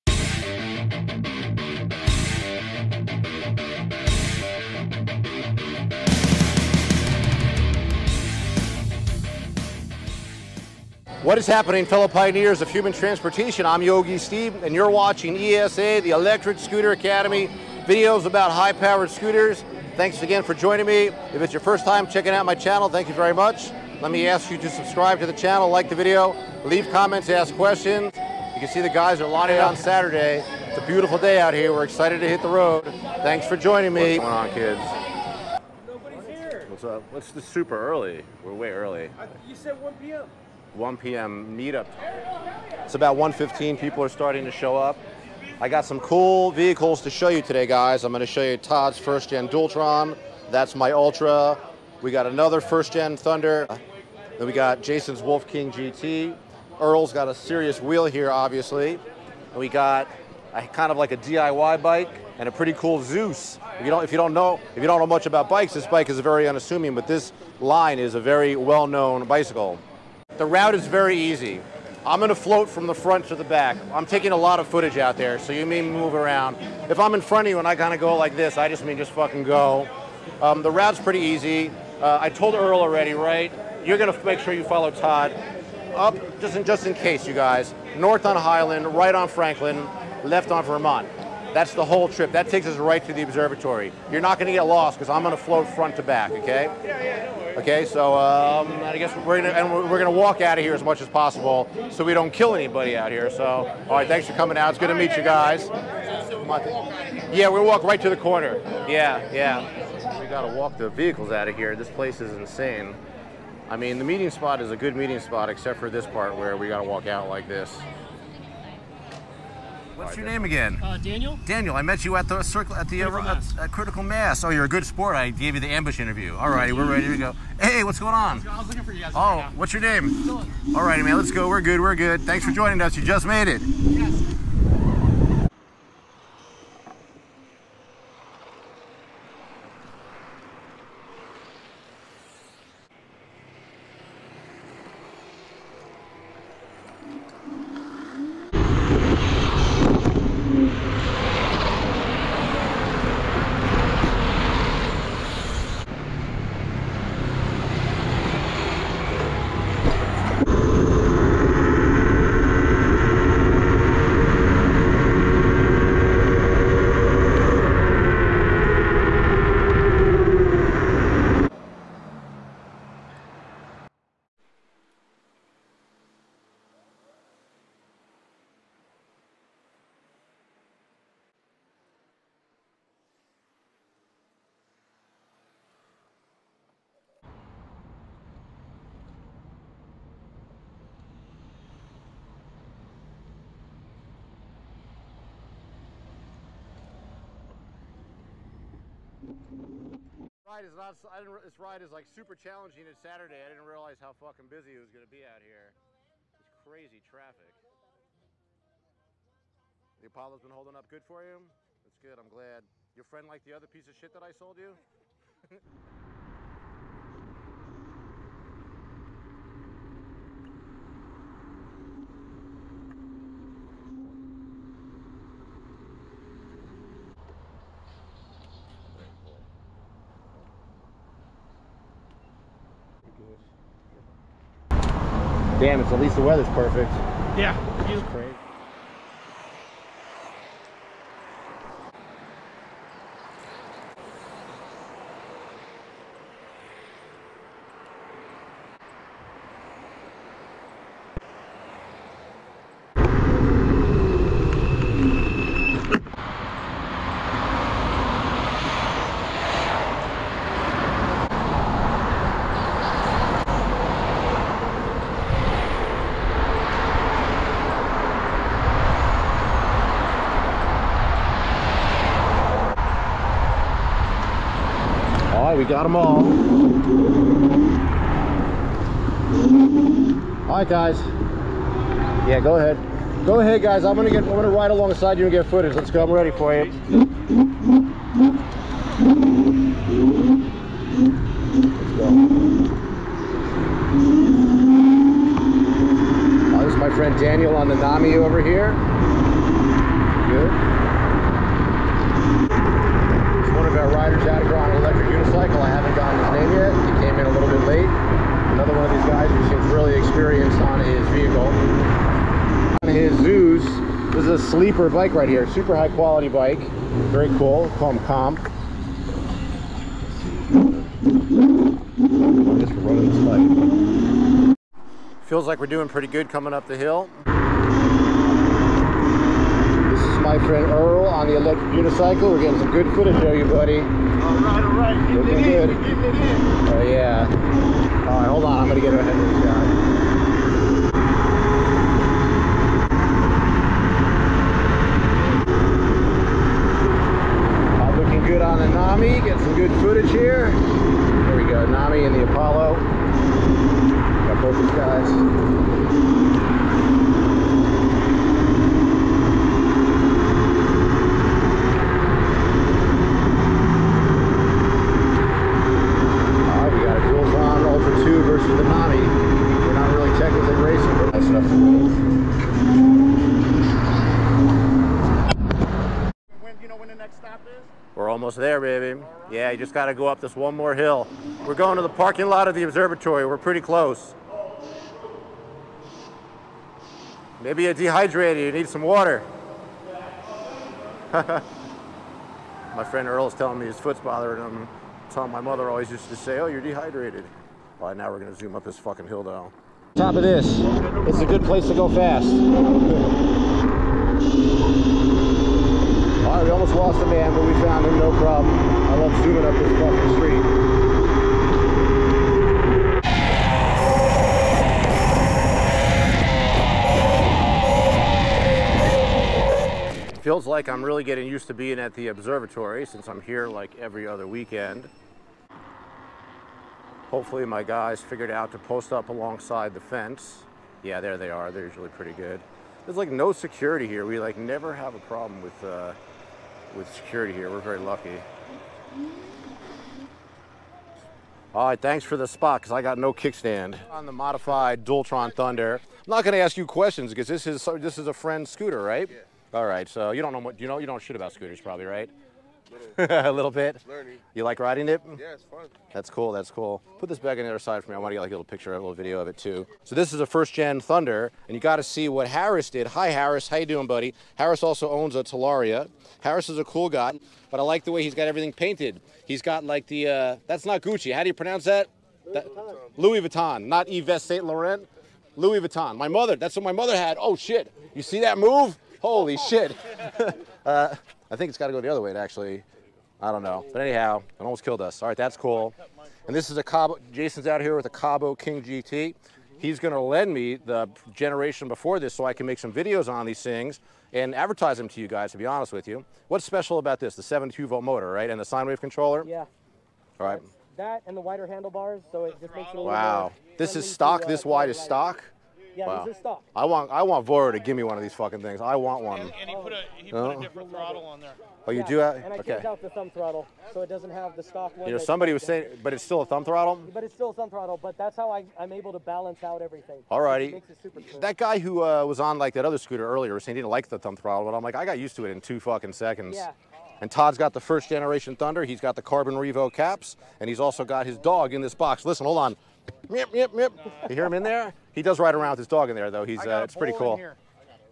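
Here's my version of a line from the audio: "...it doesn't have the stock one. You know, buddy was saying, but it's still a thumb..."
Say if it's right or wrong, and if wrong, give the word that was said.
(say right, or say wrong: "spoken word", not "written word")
wrong: "somebody", not "buddy".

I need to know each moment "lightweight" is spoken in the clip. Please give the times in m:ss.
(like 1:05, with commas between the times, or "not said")
not said.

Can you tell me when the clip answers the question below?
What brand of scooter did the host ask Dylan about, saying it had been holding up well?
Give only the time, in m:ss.
3:30.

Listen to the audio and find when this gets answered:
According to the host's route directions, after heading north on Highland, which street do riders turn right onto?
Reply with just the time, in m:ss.
1:29.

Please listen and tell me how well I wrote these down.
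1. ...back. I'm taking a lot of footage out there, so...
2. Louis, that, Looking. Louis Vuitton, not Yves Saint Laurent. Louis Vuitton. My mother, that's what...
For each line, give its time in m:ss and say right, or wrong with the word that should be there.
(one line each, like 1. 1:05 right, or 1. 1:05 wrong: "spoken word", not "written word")
1. 1:13 right
2. 7:52 wrong: "Vuitton", not "Looking".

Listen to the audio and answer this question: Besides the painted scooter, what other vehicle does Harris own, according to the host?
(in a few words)
Talaria.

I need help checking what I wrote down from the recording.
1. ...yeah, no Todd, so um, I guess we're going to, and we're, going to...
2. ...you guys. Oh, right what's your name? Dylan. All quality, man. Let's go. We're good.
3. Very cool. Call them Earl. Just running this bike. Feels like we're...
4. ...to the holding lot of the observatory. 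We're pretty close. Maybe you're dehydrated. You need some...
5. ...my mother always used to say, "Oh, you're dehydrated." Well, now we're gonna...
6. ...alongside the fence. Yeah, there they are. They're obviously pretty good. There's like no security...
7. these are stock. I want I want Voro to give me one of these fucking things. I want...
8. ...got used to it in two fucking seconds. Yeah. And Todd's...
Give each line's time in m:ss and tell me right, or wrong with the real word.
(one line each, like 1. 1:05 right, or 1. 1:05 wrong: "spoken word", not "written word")
1. 1:37 wrong: "Okay", not "Todd"
2. 2:08 wrong: "righty", not "quality"
3. 5:17 wrong: "Comp", not "Earl"
4. 6:21 wrong: "parking", not "holding"
5. 6:35 right
6. 7:09 wrong: "usually", not "obviously"
7. 8:26 right
8. 8:44 right.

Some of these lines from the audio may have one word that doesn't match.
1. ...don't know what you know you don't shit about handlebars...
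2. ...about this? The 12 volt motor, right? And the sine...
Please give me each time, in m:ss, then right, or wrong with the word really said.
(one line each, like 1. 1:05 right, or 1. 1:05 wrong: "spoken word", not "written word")
1. 7:30 wrong: "scooters", not "handlebars"
2. 8:16 wrong: "72", not "12".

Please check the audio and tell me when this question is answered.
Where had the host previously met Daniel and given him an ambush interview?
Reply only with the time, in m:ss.
2:03.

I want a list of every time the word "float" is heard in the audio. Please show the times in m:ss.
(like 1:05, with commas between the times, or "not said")
1:12, 1:35.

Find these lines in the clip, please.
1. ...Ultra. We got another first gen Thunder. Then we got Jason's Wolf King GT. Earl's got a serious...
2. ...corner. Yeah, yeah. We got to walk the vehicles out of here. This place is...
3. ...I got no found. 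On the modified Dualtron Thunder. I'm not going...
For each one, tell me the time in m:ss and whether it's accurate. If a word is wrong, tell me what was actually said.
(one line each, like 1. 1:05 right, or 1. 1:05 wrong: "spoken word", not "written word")
1. 0:50 right
2. 1:48 right
3. 7:22 wrong: "kickstand", not "found".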